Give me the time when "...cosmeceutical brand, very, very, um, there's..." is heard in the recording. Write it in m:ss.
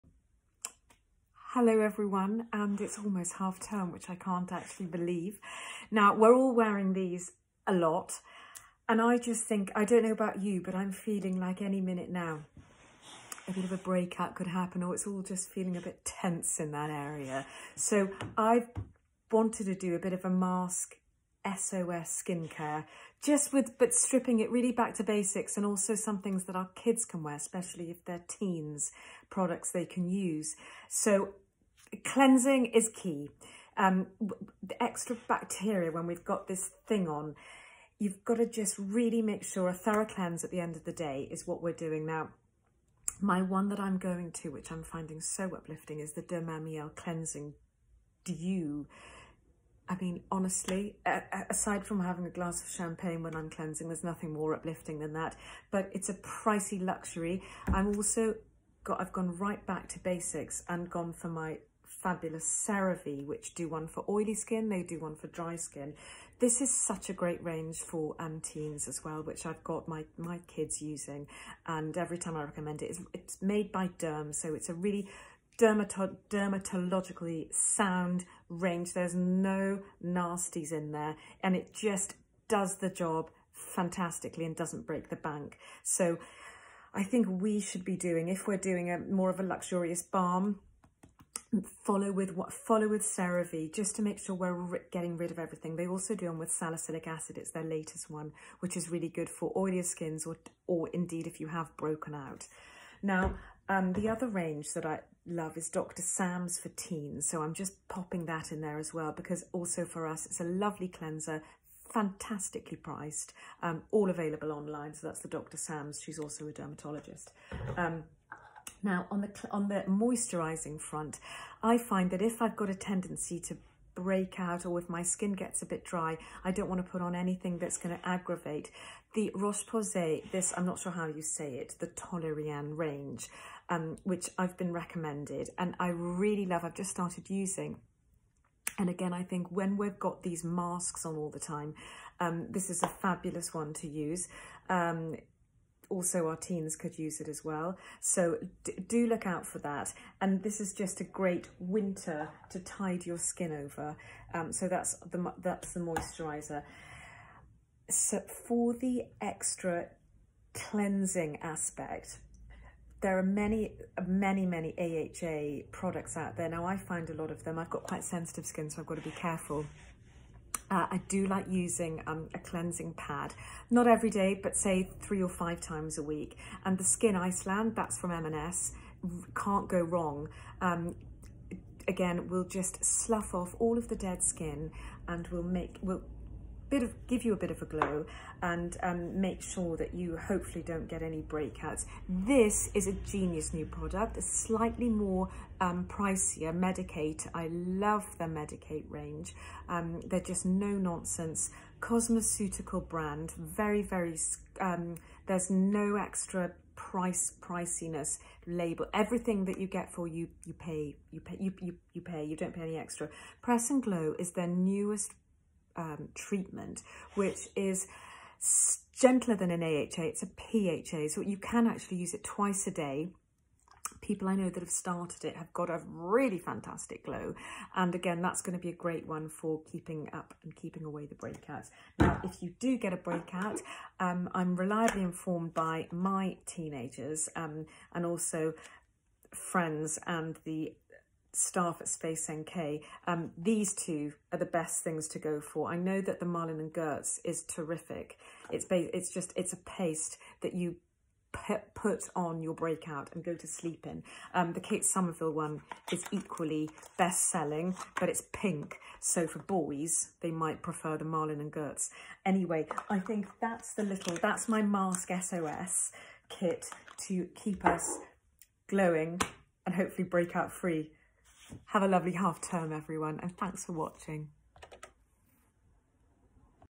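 3:21.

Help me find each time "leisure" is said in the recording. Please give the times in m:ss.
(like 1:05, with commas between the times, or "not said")
not said.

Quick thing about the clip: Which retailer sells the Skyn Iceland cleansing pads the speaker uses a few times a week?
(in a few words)
M&S.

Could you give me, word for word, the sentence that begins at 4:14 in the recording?
Um, the Kate Somerville one is equally best-selling, but it's pink.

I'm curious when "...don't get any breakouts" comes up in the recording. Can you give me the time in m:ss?
3:10.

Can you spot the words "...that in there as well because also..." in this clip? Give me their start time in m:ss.
1:48.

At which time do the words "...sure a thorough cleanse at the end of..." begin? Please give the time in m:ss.
0:39.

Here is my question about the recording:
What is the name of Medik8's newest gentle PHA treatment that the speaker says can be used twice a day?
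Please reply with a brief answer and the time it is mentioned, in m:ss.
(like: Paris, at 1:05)
Press and Glow, at 3:33.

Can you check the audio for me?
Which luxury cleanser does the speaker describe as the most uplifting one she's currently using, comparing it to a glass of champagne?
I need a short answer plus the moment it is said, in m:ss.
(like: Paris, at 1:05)
Dermamiel Cleansing Dew, at 0:46.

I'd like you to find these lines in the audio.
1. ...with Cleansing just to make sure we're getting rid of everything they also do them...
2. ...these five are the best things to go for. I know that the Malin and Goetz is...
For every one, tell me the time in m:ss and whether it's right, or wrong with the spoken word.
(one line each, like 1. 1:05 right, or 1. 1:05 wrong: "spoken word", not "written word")
1. 1:32 wrong: "CeraVe", not "Cleansing"
2. 4:03 wrong: "two", not "five".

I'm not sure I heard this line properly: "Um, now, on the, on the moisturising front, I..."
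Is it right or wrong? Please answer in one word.
right.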